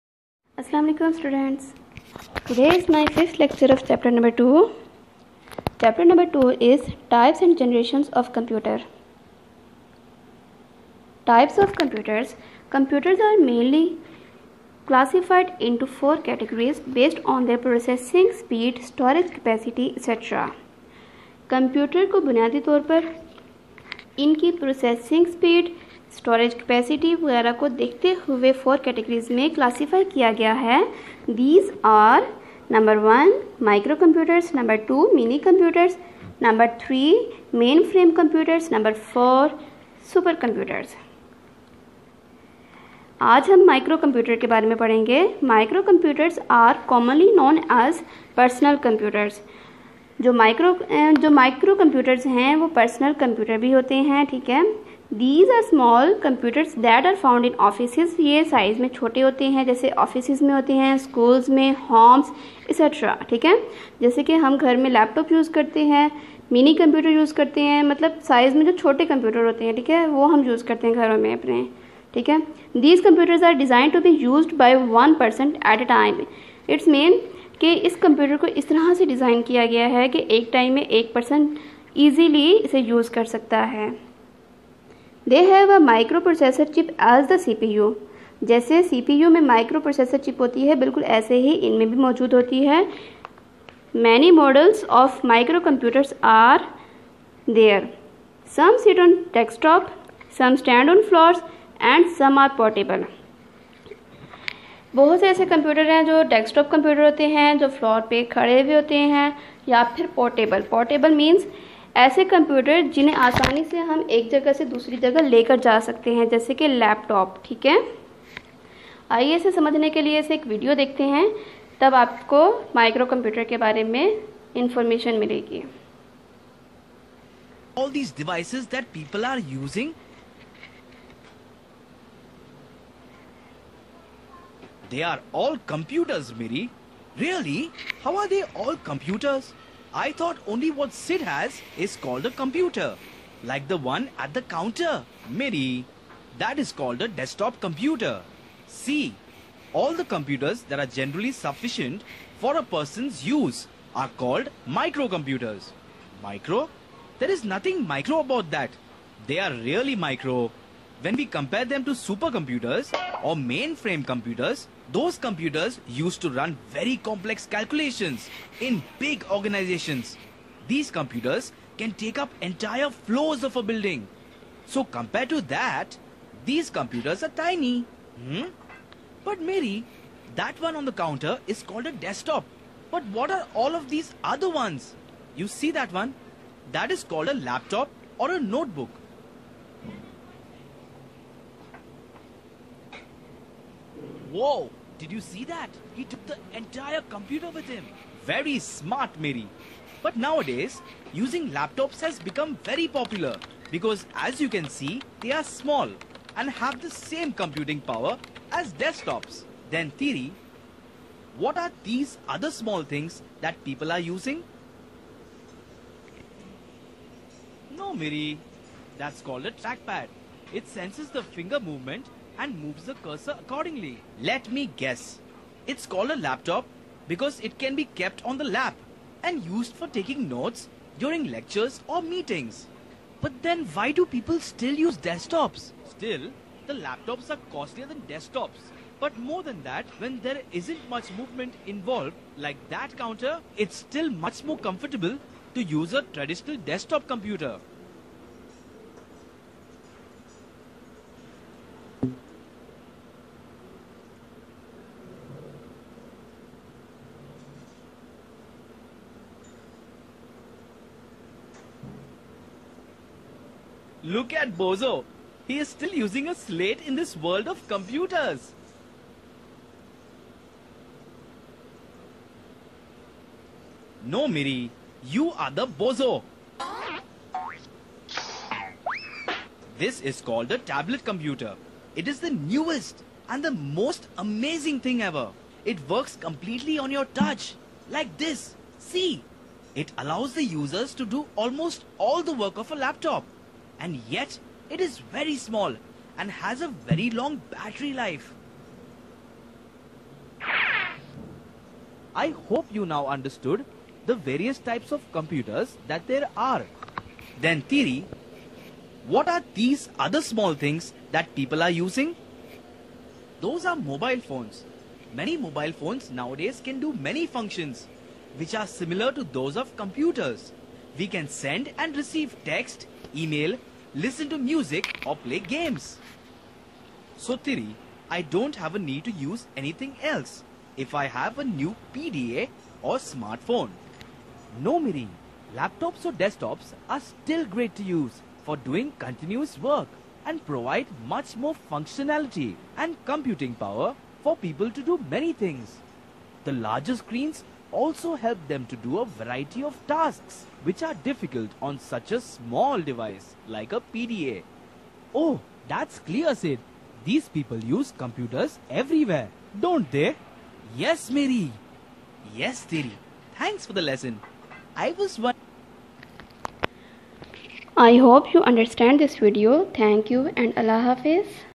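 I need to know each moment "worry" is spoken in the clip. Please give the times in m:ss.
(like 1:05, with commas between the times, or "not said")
not said.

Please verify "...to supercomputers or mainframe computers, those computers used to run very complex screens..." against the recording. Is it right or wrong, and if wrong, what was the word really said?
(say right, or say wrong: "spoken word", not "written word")
wrong: "calculations", not "screens".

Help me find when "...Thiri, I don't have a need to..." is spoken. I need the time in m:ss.
5:27.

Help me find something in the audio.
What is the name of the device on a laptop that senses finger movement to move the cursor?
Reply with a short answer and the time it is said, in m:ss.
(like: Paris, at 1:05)
Trackpad, at 3:39.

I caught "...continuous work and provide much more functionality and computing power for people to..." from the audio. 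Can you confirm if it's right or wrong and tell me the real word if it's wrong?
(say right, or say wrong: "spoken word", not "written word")
right.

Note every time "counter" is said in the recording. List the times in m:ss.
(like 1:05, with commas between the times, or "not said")
2:24, 3:00, 4:02.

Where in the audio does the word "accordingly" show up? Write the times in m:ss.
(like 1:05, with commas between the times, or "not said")
3:43.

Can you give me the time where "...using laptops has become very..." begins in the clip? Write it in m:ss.
3:21.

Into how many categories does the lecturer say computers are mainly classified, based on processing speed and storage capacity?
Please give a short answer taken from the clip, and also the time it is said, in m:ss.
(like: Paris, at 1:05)
4, at 0:16.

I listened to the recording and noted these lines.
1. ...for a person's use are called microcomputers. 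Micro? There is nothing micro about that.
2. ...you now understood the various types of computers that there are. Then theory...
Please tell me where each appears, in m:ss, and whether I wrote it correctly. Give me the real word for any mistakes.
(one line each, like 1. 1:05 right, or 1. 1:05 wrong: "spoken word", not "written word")
1. 2:32 right
2. 5:02 right.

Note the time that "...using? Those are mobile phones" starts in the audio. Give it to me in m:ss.
5:11.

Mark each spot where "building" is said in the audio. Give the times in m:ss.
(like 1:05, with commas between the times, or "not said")
2:53.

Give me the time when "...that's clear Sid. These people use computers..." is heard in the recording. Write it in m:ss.
5:55.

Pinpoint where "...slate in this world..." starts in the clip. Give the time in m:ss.
4:26.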